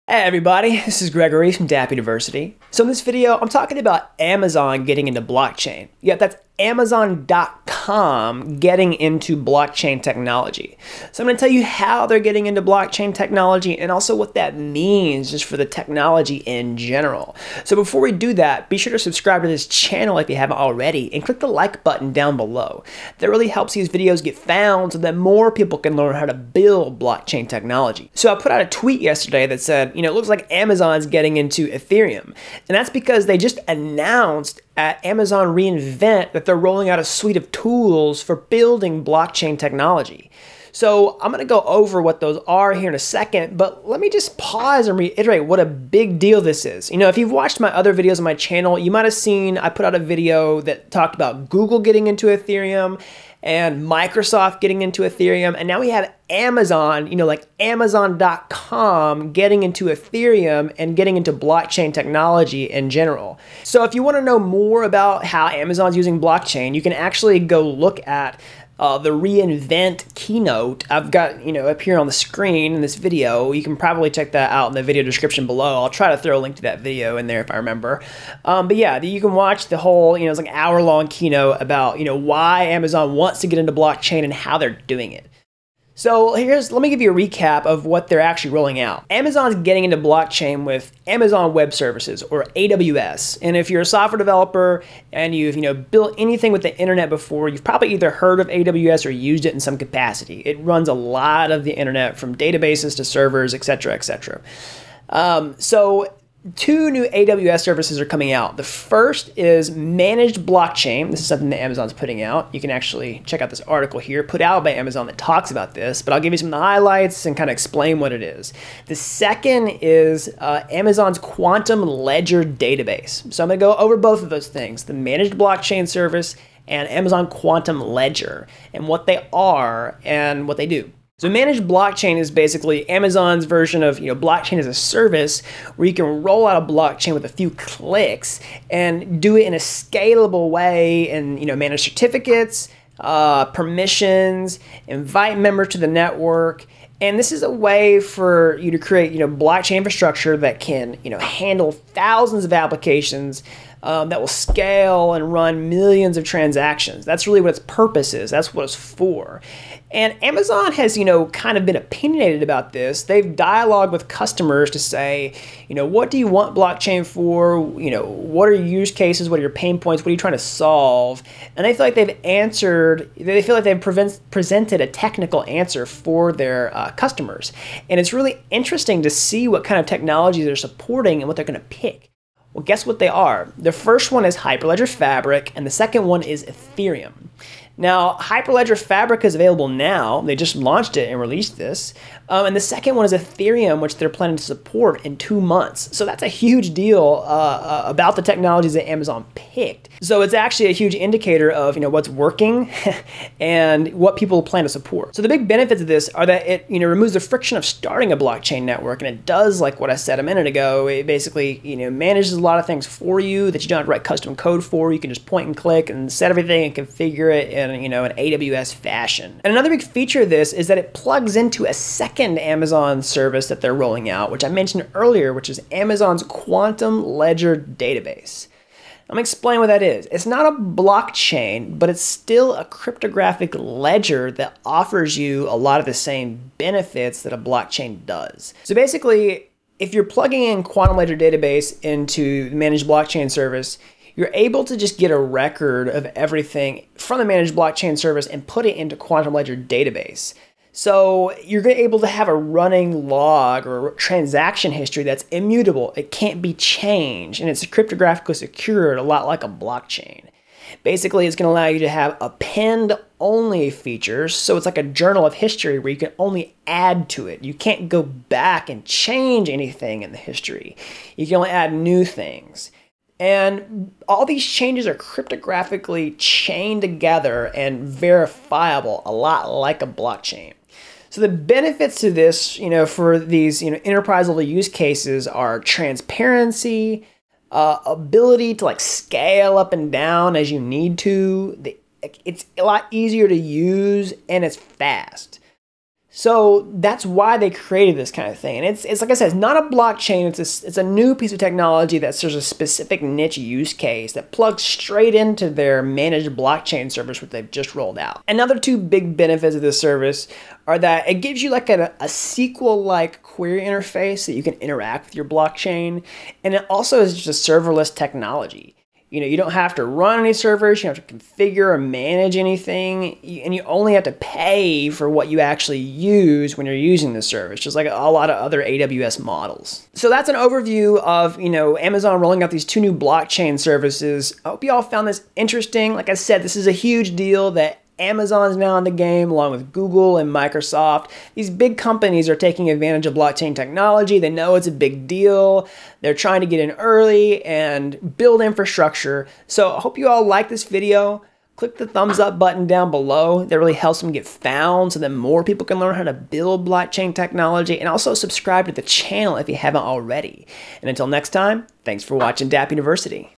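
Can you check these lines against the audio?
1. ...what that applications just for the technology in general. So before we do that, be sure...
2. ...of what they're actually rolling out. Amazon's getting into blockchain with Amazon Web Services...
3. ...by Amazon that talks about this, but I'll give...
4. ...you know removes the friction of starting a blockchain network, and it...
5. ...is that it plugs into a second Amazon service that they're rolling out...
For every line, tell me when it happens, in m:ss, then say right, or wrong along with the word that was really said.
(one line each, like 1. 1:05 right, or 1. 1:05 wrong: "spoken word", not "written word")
1. 0:14 wrong: "means", not "applications"
2. 1:27 right
3. 1:54 right
4. 3:26 right
5. 3:40 right.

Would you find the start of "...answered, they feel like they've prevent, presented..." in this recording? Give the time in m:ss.
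2:52.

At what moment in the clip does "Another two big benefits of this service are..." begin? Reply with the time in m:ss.
5:08.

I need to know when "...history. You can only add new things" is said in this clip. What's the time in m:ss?
4:30.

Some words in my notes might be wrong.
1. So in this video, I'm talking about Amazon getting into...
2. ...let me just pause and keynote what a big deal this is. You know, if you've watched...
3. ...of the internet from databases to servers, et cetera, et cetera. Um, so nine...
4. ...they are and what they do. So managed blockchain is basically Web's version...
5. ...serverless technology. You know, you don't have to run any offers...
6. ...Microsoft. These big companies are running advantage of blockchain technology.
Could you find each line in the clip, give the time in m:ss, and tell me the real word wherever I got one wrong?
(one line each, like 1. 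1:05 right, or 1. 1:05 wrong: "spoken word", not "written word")
1. 0:02 right
2. 0:43 wrong: "reiterate", not "keynote"
3. 1:41 wrong: "two", not "nine"
4. 2:09 wrong: "Amazon", not "Web"
5. 5:17 wrong: "servers", not "offers"
6. 5:40 wrong: "taking", not "running".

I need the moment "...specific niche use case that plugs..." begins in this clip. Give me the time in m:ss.
5:02.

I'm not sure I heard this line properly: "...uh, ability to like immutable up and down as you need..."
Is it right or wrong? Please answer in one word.
wrong.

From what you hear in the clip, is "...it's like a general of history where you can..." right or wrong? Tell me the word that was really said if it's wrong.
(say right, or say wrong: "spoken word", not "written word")
wrong: "journal", not "general".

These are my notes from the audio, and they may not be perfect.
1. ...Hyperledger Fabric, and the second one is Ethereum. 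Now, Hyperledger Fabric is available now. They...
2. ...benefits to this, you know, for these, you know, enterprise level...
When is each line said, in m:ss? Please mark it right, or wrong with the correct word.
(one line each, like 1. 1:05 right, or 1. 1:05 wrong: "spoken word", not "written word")
1. 3:04 right
2. 4:41 right.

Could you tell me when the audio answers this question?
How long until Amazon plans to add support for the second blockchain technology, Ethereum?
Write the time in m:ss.
3:15.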